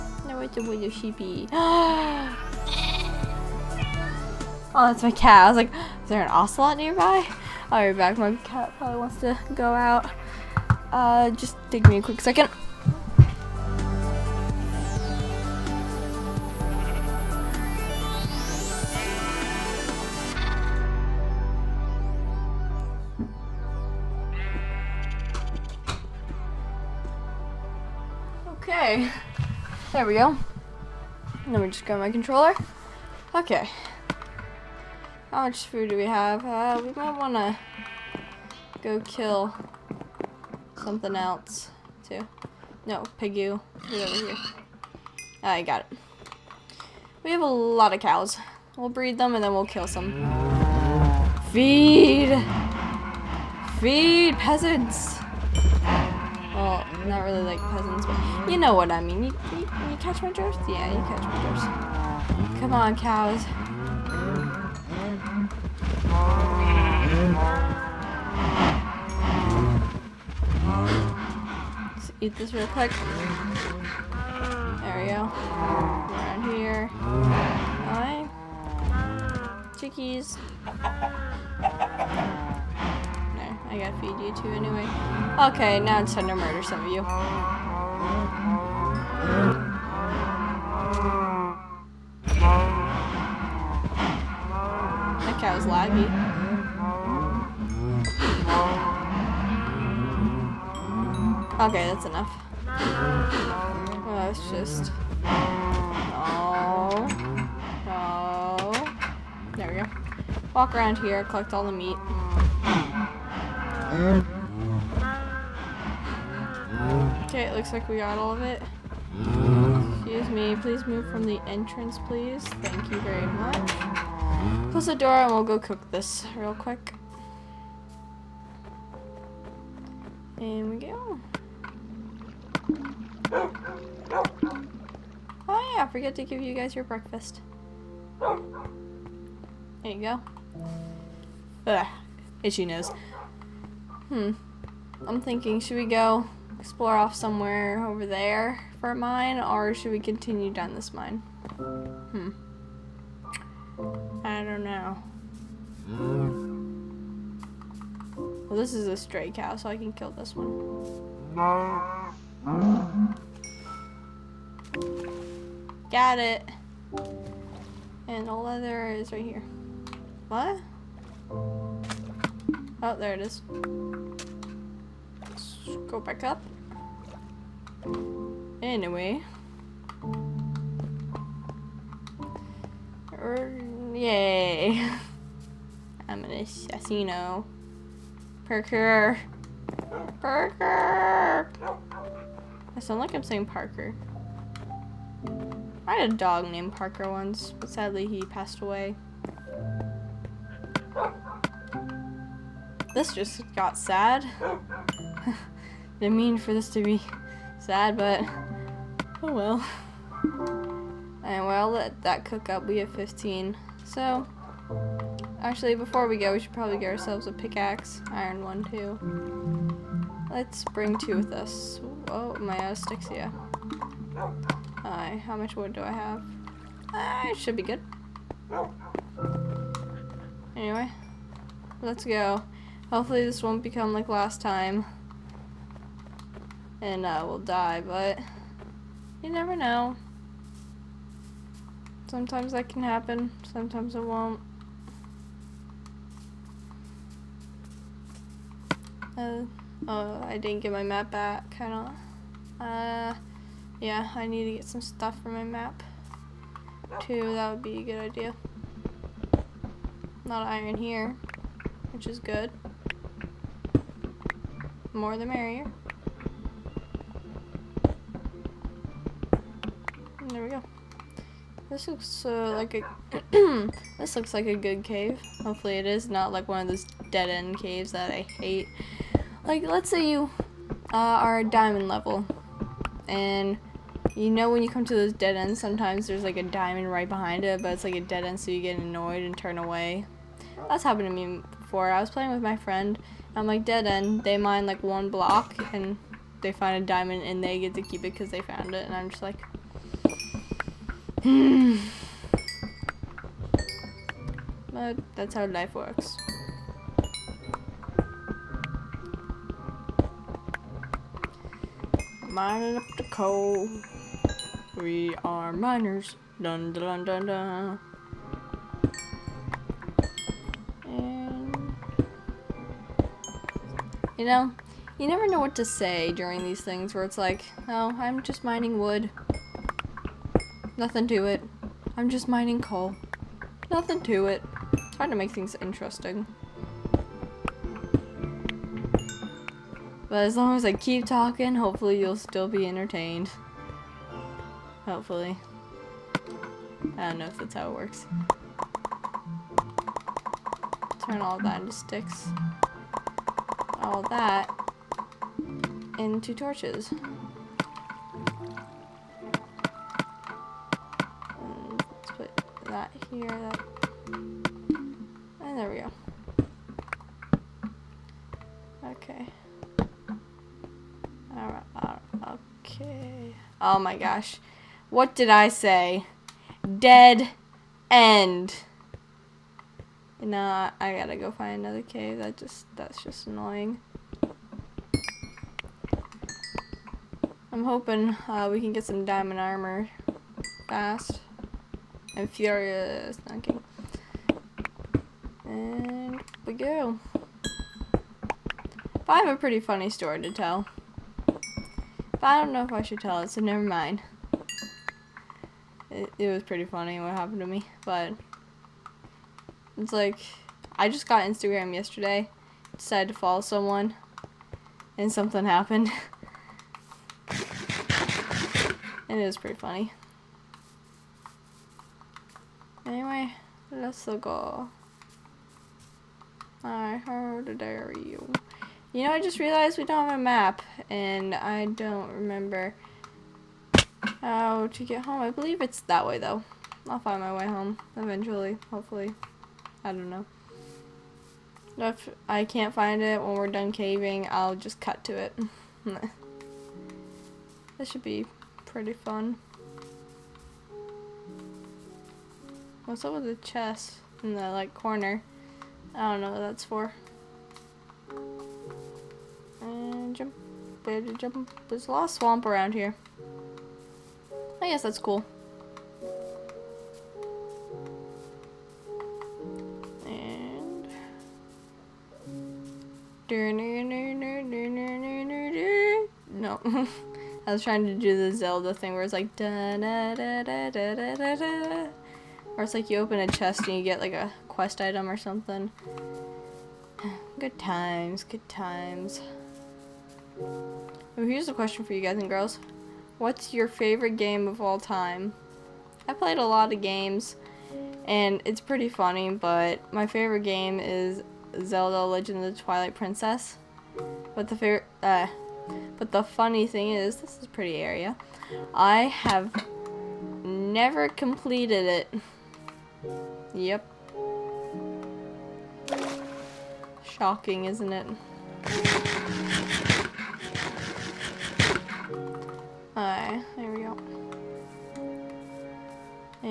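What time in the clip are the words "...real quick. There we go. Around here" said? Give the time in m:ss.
1:12.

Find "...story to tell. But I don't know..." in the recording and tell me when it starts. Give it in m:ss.
6:39.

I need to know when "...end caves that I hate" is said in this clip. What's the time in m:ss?
4:37.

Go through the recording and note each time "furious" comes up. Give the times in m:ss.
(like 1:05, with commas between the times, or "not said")
6:32.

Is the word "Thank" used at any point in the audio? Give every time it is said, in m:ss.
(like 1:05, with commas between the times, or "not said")
2:02.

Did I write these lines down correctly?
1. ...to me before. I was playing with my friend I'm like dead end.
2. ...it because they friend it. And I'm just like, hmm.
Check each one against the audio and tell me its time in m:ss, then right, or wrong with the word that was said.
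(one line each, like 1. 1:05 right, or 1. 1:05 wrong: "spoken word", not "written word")
1. 4:51 right
2. 4:58 wrong: "found", not "friend".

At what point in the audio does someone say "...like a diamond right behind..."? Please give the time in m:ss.
4:46.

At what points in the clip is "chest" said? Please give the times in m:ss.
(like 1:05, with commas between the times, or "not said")
7:33, 8:03.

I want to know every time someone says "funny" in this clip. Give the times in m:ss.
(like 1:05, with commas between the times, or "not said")
6:39, 6:46, 6:59, 8:18, 8:26.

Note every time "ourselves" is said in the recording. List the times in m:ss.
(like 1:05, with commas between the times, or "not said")
3:36.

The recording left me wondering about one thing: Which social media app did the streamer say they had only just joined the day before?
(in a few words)
Instagram.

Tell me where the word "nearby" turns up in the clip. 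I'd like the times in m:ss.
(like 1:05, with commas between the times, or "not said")
0:06.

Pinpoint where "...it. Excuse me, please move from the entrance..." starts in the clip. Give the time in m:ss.
1:58.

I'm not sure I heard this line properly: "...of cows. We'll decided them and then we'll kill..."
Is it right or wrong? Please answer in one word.
wrong.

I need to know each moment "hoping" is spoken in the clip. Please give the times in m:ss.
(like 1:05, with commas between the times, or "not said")
6:27.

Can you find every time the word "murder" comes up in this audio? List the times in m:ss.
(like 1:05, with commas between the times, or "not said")
1:26.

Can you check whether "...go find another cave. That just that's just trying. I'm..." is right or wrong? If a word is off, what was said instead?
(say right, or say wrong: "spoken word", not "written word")
wrong: "annoying", not "trying".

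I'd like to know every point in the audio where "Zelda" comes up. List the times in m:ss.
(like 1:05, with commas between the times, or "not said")
7:58, 8:21.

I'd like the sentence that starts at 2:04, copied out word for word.
Close the door and we'll go cook this real quick.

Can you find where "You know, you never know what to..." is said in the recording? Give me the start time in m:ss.
5:24.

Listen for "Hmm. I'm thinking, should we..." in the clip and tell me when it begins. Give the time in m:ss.
2:24.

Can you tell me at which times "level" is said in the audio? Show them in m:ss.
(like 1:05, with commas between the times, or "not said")
4:41.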